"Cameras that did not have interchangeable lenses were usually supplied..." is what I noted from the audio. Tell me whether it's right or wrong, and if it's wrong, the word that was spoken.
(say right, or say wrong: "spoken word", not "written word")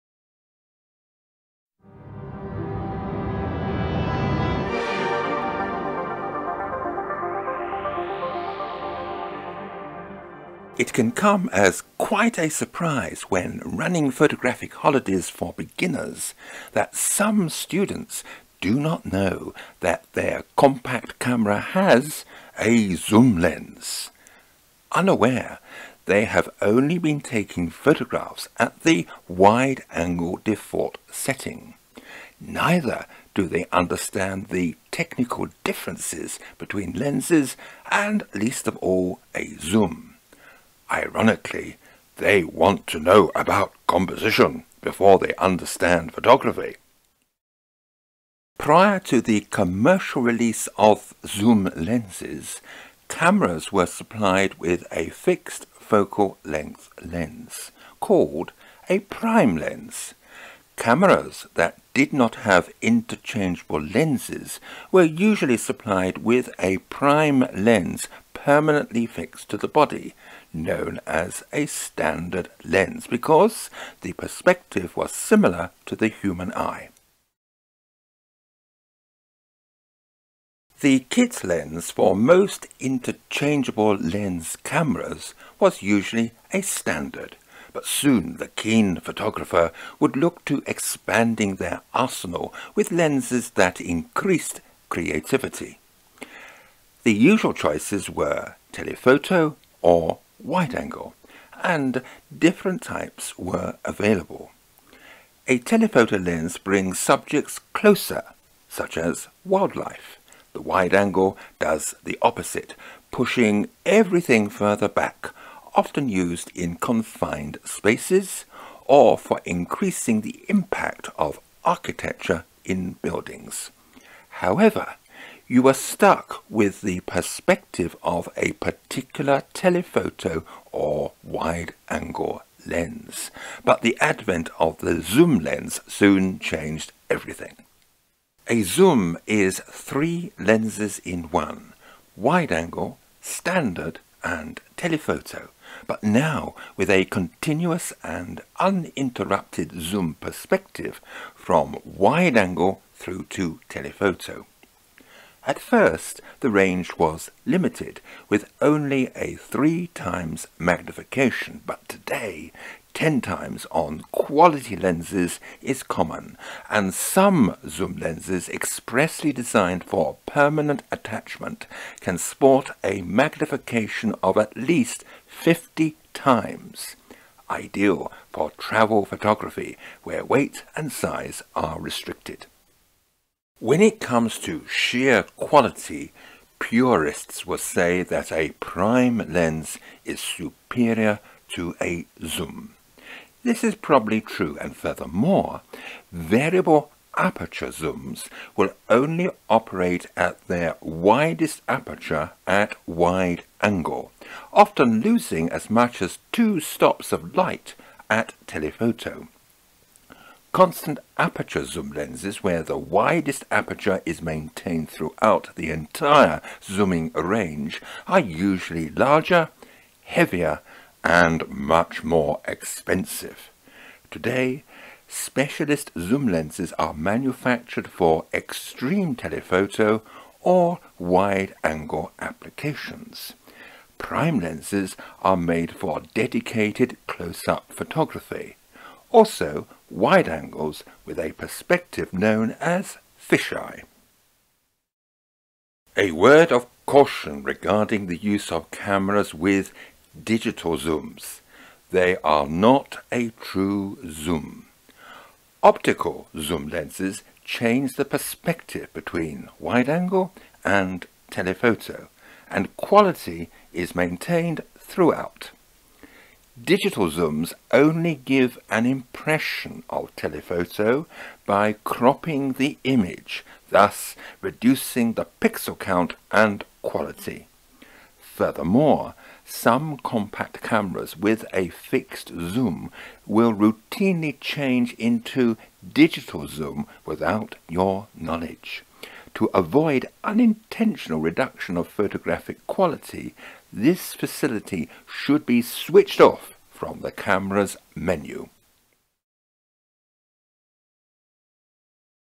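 right.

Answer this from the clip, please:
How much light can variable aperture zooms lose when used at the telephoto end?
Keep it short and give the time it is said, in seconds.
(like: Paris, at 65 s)
2 stops, at 206 s.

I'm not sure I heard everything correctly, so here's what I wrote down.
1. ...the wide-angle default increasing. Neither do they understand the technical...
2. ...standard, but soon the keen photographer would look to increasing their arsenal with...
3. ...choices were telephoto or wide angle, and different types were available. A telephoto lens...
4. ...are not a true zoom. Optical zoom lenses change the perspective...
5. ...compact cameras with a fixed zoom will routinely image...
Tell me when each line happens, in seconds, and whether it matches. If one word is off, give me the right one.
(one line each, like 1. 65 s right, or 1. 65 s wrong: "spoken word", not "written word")
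1. 28 s wrong: "setting", not "increasing"
2. 86 s wrong: "expanding", not "increasing"
3. 97 s right
4. 252 s right
5. 279 s wrong: "change", not "image".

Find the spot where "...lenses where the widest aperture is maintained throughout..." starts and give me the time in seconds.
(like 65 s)
211 s.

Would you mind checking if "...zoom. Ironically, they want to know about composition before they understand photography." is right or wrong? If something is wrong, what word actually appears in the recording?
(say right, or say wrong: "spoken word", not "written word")
right.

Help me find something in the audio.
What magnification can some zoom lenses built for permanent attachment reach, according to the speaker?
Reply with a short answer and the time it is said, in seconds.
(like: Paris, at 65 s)
at least 50 times, at 174 s.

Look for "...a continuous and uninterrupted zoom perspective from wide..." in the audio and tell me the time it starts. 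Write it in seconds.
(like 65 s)
146 s.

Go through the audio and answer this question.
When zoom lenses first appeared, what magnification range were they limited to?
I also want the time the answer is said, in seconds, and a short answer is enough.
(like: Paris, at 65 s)
3 times, at 159 s.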